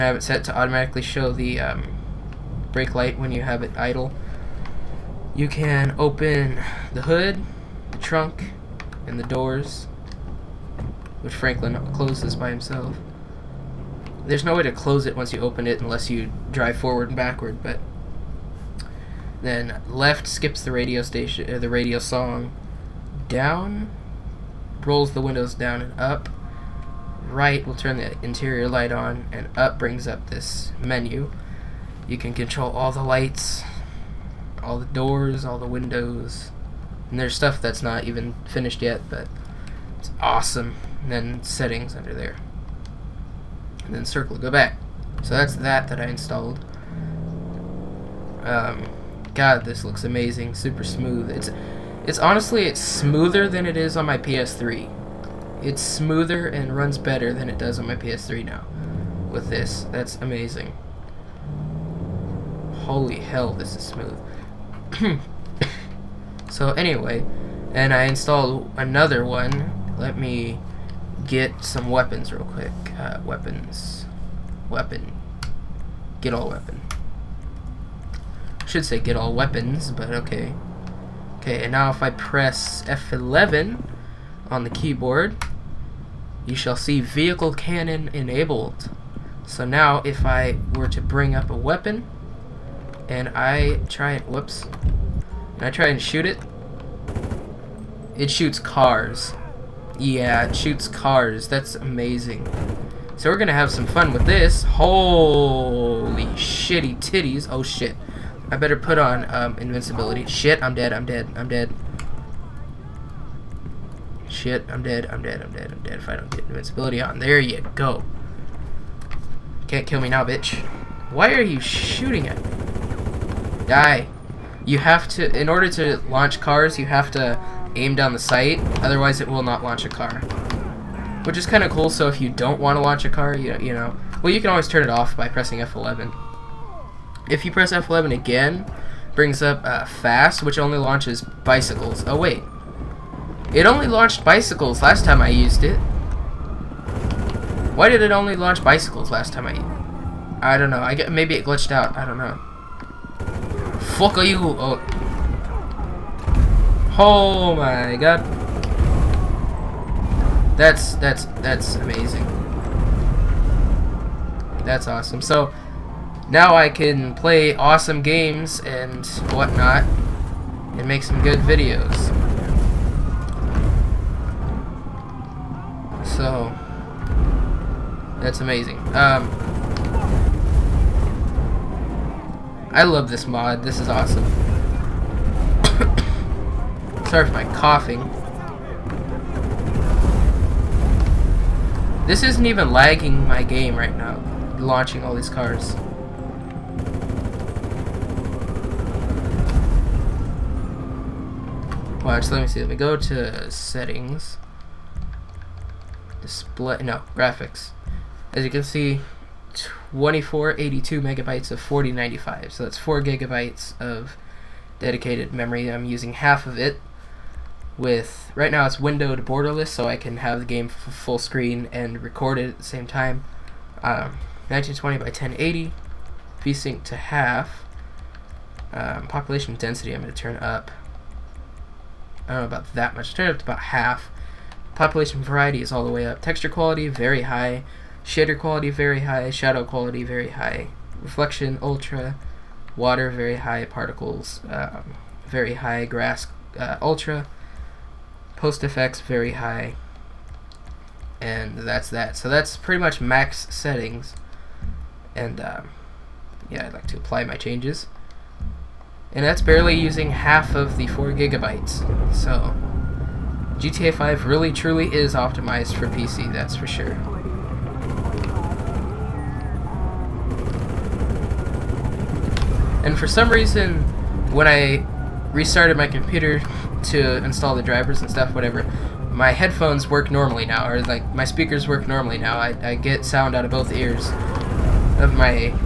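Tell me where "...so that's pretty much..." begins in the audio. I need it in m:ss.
4:12.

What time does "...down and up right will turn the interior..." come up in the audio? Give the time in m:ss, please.
0:25.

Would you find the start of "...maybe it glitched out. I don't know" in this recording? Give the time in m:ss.
2:31.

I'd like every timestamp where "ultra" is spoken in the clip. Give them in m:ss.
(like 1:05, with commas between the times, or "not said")
4:01, 4:06.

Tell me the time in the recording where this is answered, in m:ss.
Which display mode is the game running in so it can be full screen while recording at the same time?
3:38.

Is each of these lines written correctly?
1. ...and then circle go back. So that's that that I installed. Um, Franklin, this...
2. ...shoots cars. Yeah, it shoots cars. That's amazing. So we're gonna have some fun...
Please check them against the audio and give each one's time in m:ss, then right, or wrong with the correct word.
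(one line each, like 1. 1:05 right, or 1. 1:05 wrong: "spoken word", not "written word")
1. 0:43 wrong: "God", not "Franklin"
2. 1:38 right.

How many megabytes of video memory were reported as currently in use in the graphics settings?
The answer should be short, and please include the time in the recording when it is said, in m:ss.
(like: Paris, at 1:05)
2482, at 3:29.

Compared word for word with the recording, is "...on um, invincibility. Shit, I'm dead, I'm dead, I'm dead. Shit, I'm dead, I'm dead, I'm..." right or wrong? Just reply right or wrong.
right.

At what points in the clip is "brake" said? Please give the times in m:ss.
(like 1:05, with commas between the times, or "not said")
0:02.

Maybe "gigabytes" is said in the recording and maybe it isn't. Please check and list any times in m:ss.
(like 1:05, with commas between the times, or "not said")
3:33, 4:21.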